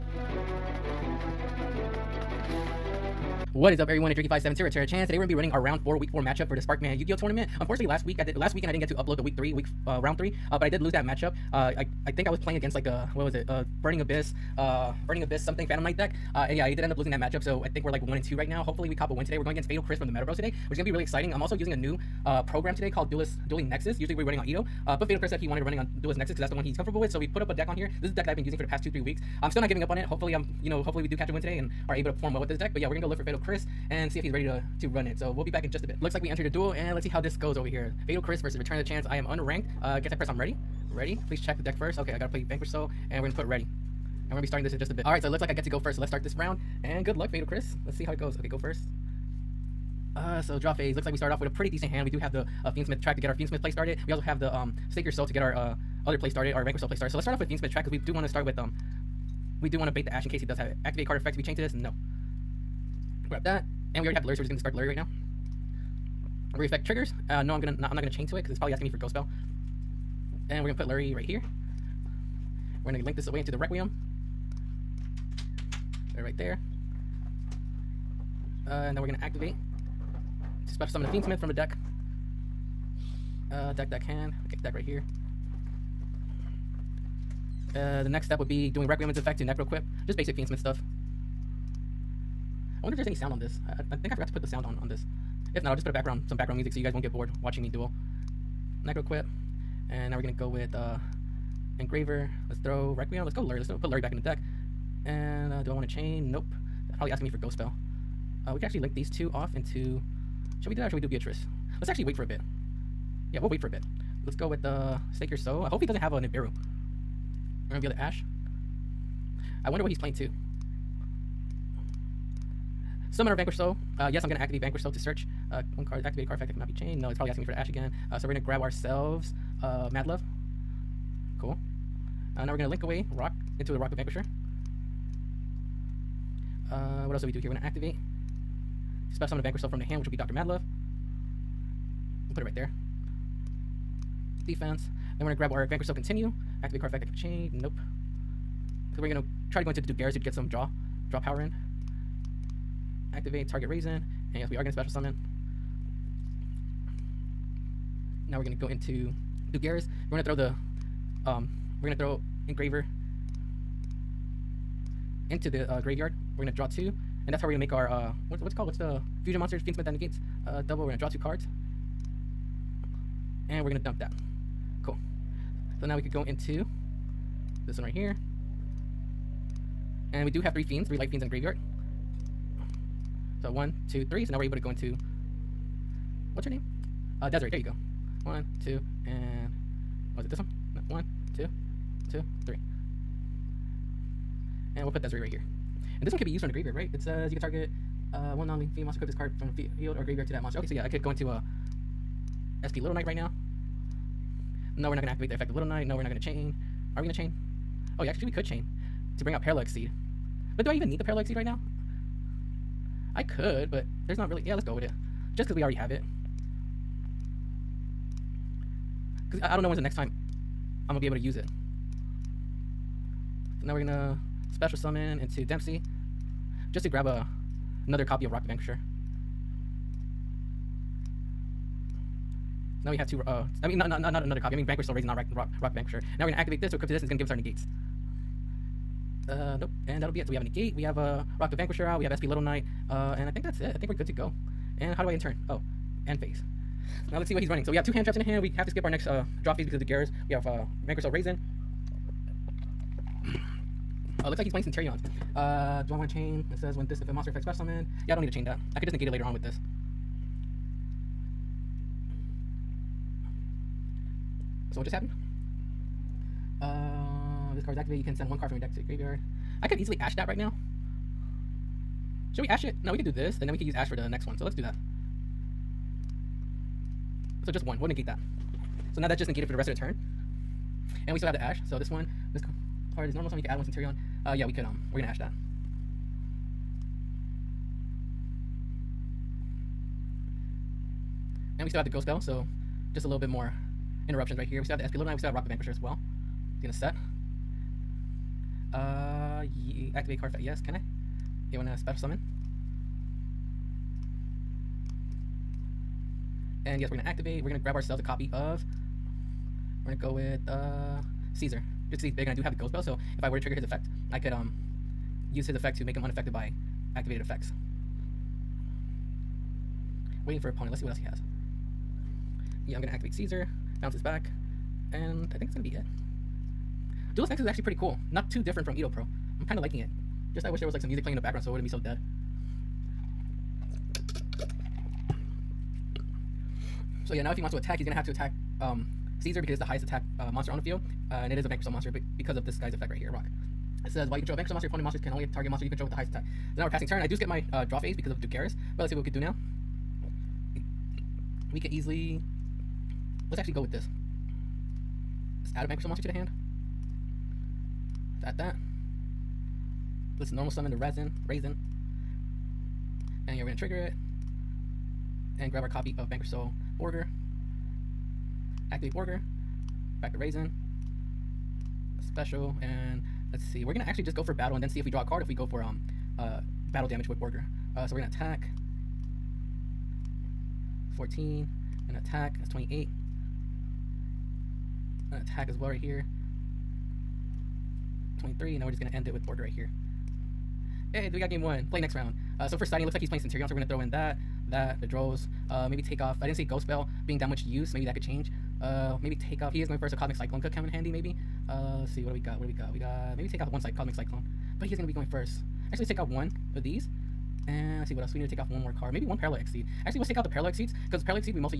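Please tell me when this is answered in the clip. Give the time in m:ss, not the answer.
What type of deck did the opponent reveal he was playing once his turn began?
4:14.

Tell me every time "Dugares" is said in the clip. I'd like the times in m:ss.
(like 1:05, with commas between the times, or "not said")
2:29, 2:39, 4:09, 5:48.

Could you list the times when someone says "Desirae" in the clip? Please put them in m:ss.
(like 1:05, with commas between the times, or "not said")
3:07, 3:15.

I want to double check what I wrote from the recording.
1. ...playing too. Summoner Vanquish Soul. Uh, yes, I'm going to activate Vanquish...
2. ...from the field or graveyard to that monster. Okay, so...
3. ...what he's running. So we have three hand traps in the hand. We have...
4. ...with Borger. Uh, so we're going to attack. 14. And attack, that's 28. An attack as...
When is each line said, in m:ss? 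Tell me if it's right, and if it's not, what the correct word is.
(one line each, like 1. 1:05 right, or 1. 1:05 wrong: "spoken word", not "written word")
1. 1:59 right
2. 3:19 right
3. 4:07 wrong: "two", not "three"
4. 6:17 right.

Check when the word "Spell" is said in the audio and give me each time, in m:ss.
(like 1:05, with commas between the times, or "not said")
1:09, 1:47, 2:19.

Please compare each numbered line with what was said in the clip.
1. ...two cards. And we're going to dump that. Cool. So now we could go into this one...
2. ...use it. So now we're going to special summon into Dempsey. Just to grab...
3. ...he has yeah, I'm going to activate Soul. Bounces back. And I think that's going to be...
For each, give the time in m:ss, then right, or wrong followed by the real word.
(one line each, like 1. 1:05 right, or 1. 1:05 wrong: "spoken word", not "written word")
1. 2:51 right
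2. 3:41 right
3. 5:21 wrong: "Caesar", not "Soul".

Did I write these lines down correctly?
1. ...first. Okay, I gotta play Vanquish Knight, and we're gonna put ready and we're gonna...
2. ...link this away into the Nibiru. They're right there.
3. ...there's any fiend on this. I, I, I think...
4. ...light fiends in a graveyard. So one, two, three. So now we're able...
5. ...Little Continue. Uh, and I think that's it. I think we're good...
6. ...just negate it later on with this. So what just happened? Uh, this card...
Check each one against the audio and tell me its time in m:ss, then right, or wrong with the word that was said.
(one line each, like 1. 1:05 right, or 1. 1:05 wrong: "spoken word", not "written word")
1. 0:41 wrong: "Soul", not "Knight"
2. 1:13 wrong: "Requiem", not "Nibiru"
3. 1:32 wrong: "sound", not "fiend"
4. 3:00 right
5. 4:02 wrong: "Knight", not "Continue"
6. 4:18 right.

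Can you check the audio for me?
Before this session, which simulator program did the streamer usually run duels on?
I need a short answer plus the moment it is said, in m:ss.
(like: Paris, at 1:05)
Ito, at 0:24.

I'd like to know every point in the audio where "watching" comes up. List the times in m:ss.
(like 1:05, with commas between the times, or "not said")
1:37.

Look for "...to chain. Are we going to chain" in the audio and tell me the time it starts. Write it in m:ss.
3:26.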